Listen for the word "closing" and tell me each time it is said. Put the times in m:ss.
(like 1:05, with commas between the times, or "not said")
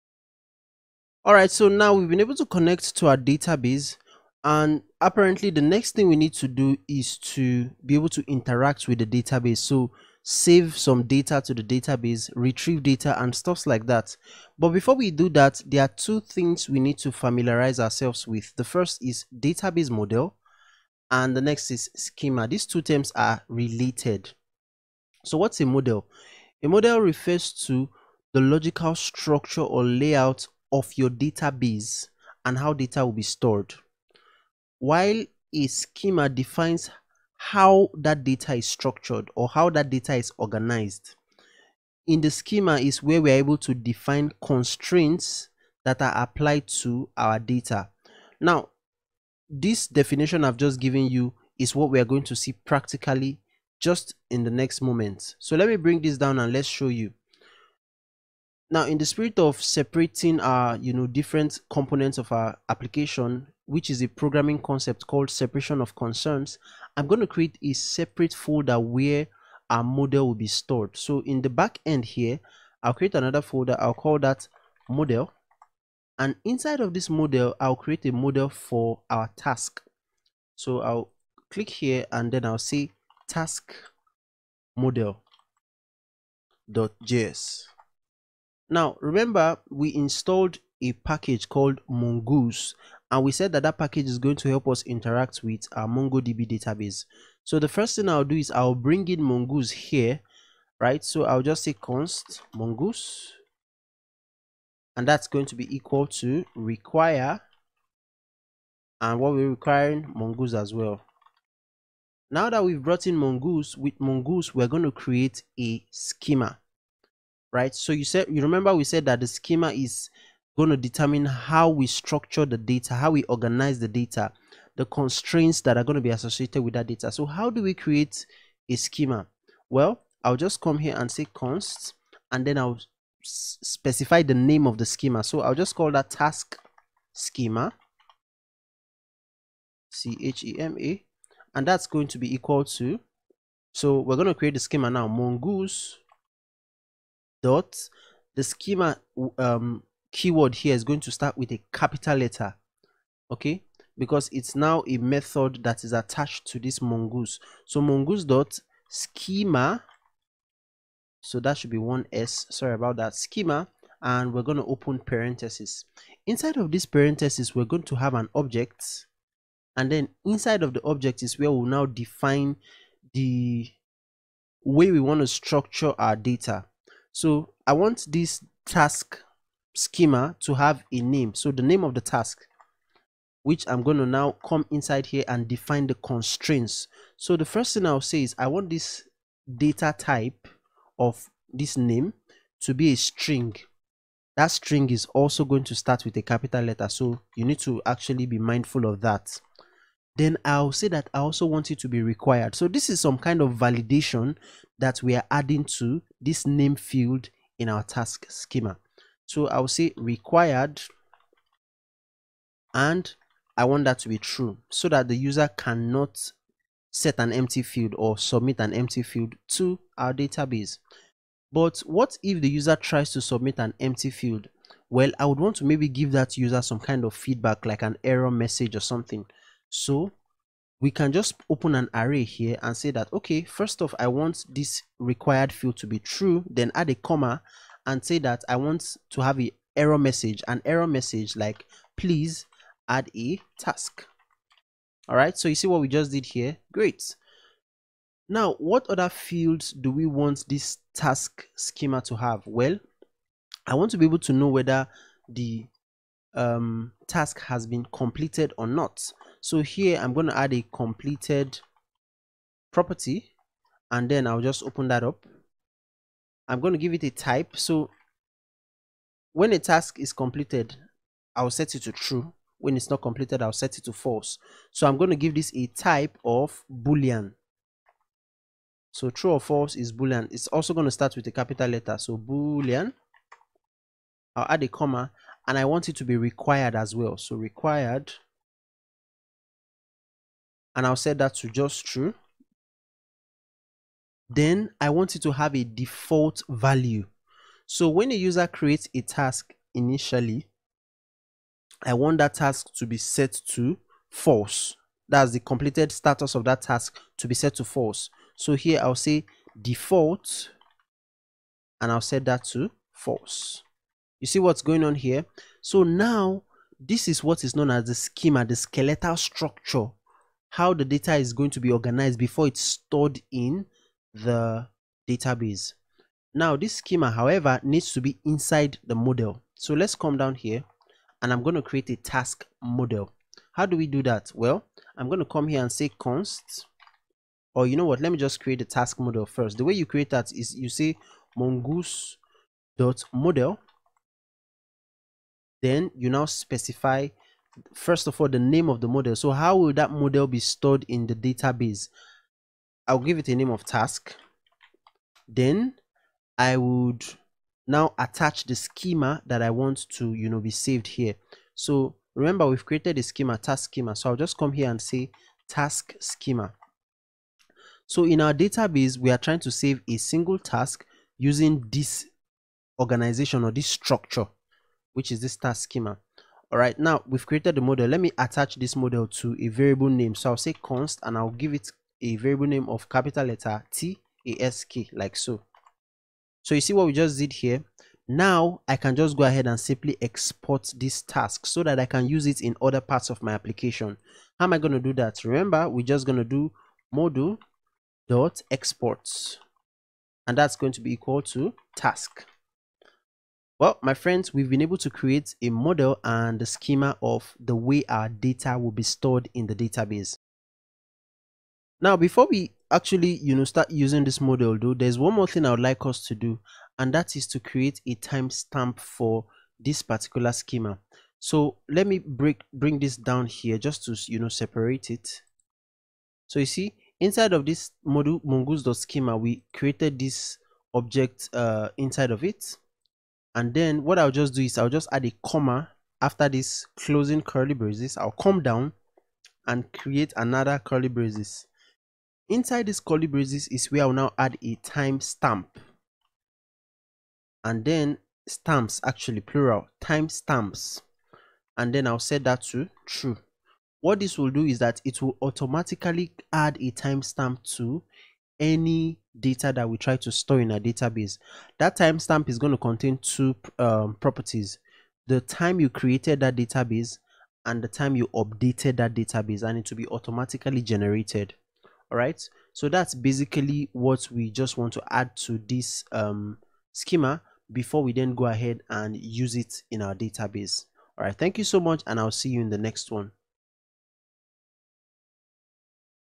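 7:16.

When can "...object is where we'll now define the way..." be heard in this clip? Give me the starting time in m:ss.
2:50.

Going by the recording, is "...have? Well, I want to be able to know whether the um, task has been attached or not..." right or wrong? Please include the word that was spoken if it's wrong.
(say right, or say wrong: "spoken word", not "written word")
wrong: "completed", not "attached".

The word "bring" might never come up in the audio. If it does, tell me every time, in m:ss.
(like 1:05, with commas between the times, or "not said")
0:55, 1:38, 7:02.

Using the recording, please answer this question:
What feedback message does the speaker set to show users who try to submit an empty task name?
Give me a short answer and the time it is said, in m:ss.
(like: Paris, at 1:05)
Please add a task, at 4:01.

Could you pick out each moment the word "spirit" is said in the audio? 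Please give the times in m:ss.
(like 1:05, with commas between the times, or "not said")
0:59.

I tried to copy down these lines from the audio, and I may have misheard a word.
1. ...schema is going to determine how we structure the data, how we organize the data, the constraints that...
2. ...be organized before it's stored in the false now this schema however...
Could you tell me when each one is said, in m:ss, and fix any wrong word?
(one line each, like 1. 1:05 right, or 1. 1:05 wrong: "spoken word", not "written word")
1. 1:59 right
2. 5:21 wrong: "database", not "false".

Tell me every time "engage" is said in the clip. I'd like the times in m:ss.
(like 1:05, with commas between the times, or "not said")
not said.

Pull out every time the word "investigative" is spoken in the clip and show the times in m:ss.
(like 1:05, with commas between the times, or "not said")
not said.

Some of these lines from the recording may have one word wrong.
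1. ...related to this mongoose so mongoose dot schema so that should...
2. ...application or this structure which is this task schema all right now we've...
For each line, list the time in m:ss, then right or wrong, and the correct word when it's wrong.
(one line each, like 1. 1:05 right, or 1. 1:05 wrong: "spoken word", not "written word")
1. 2:35 wrong: "attached", not "related"
2. 6:12 wrong: "organization", not "application".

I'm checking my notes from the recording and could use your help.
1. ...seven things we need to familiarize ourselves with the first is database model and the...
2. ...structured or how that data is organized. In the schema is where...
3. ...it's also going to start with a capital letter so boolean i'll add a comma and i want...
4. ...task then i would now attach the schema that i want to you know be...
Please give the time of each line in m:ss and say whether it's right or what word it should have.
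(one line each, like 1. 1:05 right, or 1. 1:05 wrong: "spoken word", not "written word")
1. 0:15 wrong: "two", not "seven"
2. 0:38 right
3. 4:40 right
4. 5:53 right.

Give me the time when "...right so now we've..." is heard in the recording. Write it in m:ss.
0:01.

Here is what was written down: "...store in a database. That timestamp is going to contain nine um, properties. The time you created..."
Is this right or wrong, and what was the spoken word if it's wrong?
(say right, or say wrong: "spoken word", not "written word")
wrong: "two", not "nine".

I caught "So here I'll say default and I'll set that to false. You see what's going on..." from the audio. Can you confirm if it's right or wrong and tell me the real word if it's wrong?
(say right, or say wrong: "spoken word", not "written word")
right.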